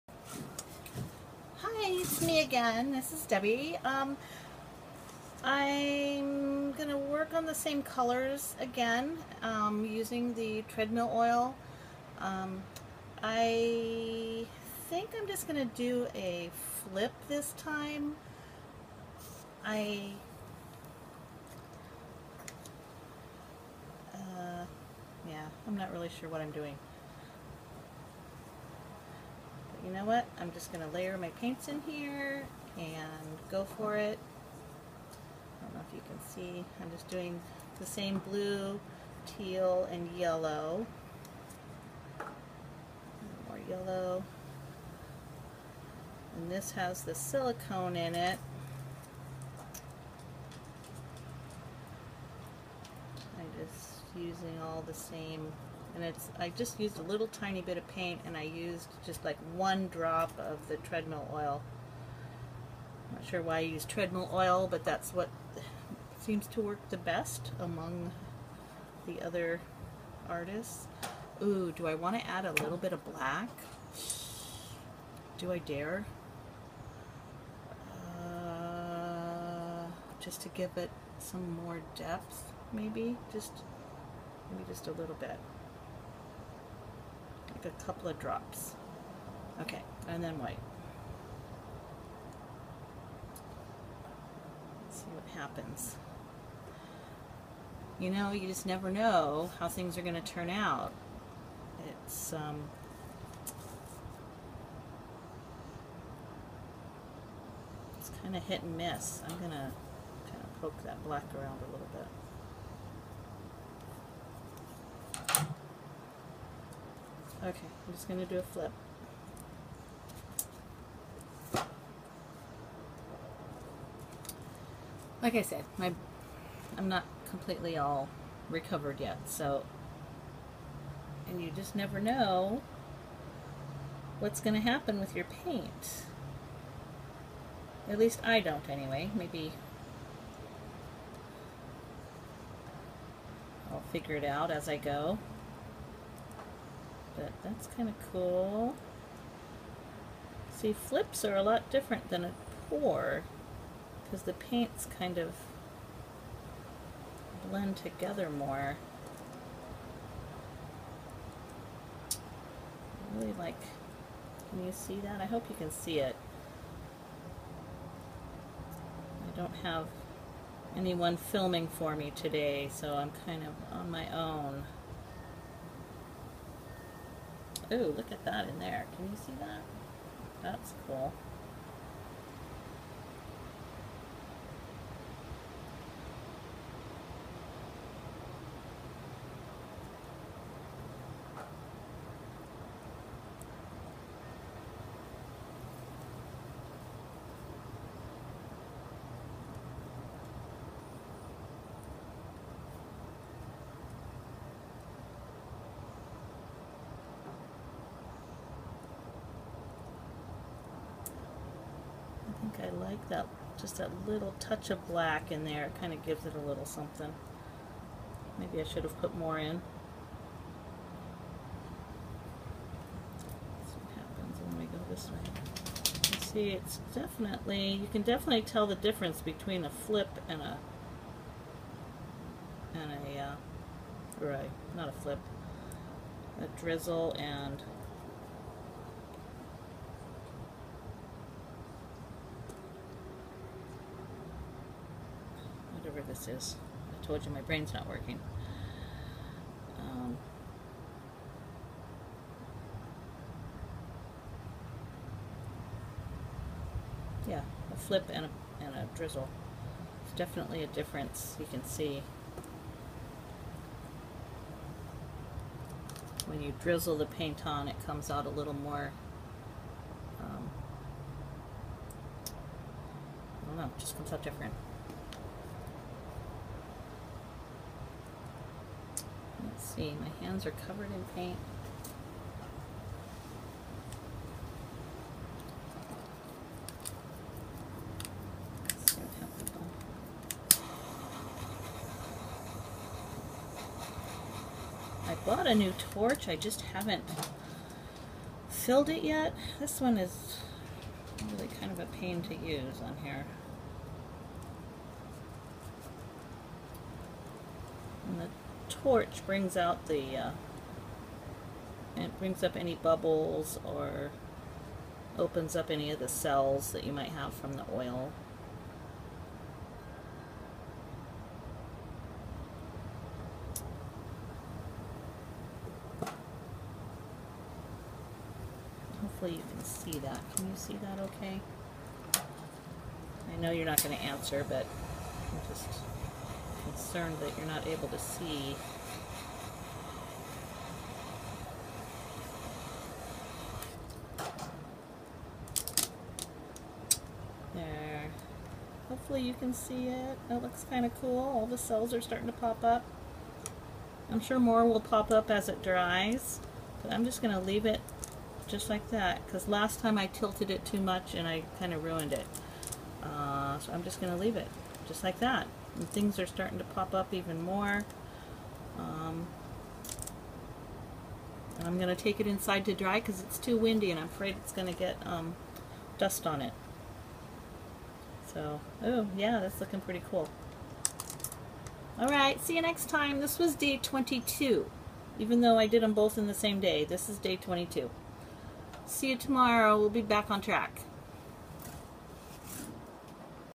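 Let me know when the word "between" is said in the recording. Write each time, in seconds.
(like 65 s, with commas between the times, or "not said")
229 s.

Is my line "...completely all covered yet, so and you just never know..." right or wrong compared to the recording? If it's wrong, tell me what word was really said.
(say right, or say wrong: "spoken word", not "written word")
wrong: "recovered", not "covered".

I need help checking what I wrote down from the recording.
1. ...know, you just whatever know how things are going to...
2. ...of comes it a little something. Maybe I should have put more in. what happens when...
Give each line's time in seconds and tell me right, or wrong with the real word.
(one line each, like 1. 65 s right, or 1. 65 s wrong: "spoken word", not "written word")
1. 98 s wrong: "never", not "whatever"
2. 215 s wrong: "gives", not "comes".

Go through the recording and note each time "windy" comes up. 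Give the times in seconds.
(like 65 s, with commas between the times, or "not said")
373 s.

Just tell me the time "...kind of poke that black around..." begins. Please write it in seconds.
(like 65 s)
110 s.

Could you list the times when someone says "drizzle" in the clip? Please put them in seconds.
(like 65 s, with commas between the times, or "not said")
236 s, 258 s, 266 s.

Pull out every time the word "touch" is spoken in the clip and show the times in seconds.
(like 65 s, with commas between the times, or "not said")
214 s.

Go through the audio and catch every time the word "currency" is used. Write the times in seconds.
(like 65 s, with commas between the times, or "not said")
not said.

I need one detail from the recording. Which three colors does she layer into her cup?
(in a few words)
blue, teal, and yellow.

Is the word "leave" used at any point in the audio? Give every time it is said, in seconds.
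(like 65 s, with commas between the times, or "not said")
357 s, 364 s.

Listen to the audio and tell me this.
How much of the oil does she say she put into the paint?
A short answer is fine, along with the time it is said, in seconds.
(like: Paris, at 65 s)
1 drop, at 59 s.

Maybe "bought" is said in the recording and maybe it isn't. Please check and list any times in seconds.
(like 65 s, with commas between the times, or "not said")
295 s.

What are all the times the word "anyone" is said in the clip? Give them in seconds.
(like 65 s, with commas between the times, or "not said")
170 s.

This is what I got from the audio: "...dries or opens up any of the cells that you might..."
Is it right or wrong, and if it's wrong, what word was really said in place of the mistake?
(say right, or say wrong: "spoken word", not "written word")
wrong: "bubbles", not "dries".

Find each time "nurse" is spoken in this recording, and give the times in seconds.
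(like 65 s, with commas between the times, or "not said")
not said.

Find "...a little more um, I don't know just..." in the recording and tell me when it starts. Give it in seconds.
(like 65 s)
268 s.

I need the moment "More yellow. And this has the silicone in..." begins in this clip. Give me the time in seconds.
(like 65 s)
43 s.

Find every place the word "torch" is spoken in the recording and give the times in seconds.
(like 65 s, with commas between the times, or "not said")
295 s, 308 s.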